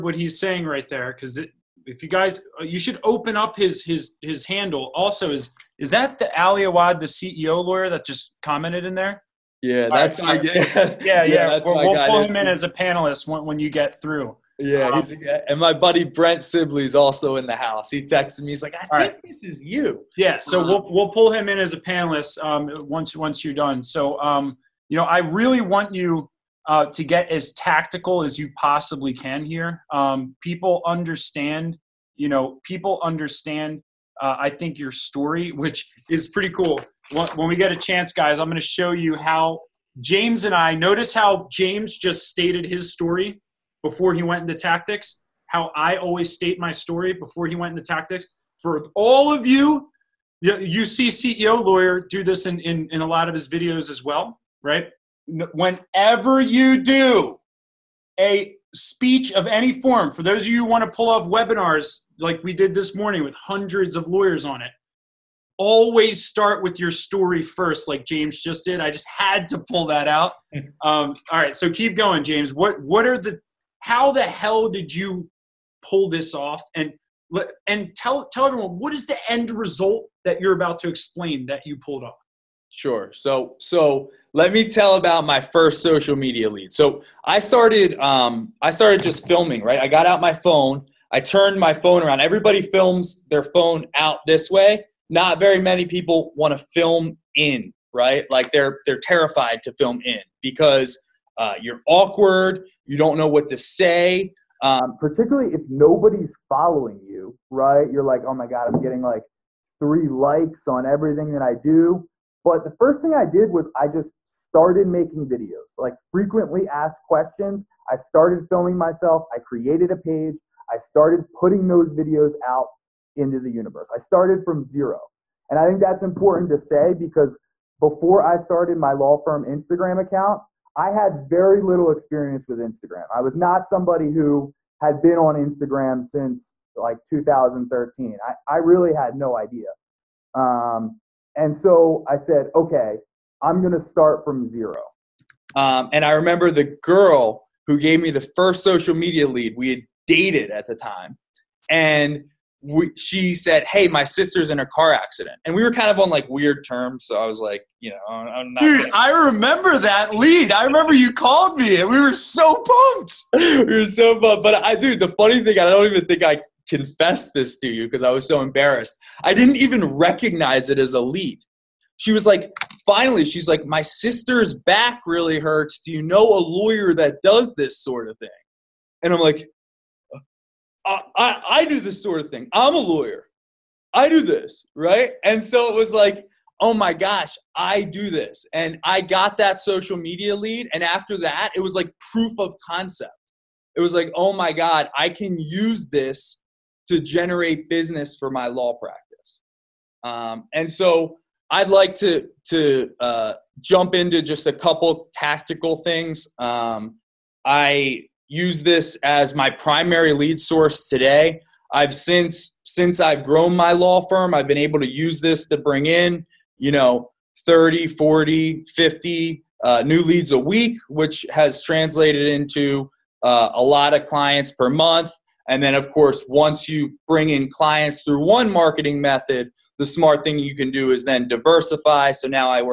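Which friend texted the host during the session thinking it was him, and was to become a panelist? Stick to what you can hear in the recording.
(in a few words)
Brent Sibley.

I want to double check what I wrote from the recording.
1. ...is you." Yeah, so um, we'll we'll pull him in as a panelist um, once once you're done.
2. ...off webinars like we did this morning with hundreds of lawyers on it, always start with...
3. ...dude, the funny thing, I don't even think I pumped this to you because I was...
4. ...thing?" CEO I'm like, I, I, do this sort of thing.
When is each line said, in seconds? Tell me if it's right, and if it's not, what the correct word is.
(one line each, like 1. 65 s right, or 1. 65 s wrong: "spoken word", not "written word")
1. 19 s right
2. 61 s right
3. 164 s wrong: "confessed", not "pumped"
4. 178 s wrong: "And", not "CEO".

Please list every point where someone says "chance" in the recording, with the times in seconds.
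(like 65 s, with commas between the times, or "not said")
37 s.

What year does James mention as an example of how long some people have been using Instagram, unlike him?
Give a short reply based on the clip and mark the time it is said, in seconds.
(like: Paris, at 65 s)
2013, at 137 s.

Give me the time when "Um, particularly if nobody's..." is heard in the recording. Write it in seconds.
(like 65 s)
104 s.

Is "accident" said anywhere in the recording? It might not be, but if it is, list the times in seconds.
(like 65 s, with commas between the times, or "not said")
154 s.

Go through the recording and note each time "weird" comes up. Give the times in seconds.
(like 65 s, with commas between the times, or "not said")
156 s.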